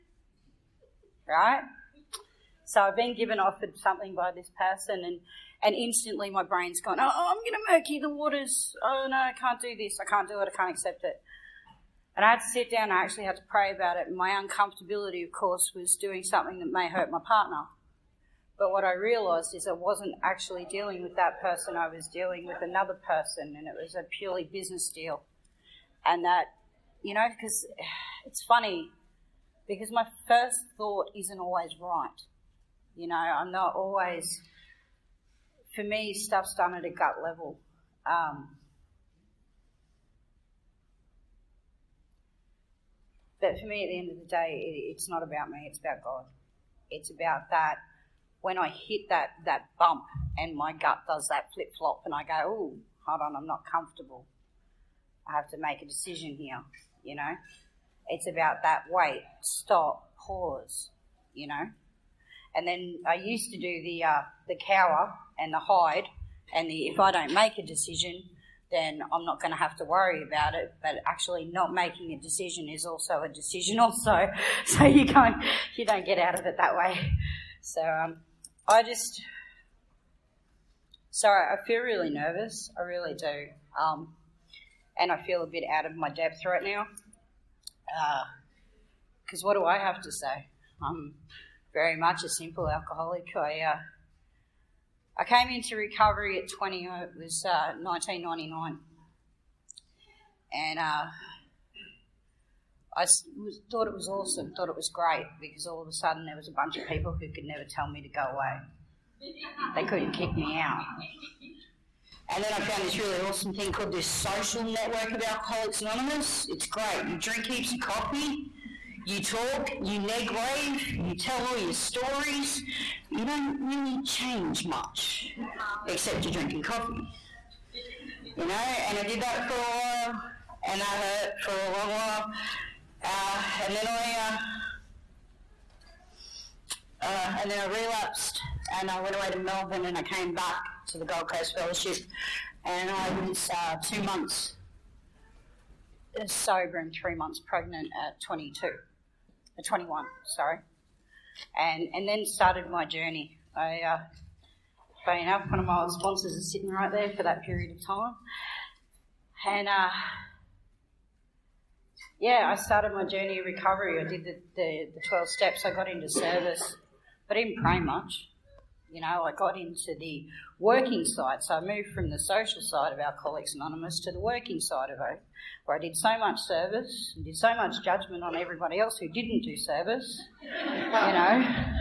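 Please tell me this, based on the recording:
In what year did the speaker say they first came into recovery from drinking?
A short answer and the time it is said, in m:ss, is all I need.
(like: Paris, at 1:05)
1999, at 1:37.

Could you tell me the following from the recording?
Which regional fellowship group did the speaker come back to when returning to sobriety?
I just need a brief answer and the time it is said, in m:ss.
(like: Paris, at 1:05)
Gold Coast Fellowship, at 2:21.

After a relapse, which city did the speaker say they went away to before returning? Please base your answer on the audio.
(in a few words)
Melbourne.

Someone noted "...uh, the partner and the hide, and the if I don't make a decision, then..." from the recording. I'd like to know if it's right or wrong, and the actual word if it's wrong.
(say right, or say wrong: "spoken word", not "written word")
wrong: "cower", not "partner".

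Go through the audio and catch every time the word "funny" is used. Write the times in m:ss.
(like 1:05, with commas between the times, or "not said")
0:28, 2:35.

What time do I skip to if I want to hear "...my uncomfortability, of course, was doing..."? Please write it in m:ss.
0:14.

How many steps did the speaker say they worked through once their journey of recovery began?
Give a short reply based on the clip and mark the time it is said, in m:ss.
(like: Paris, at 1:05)
12, at 2:45.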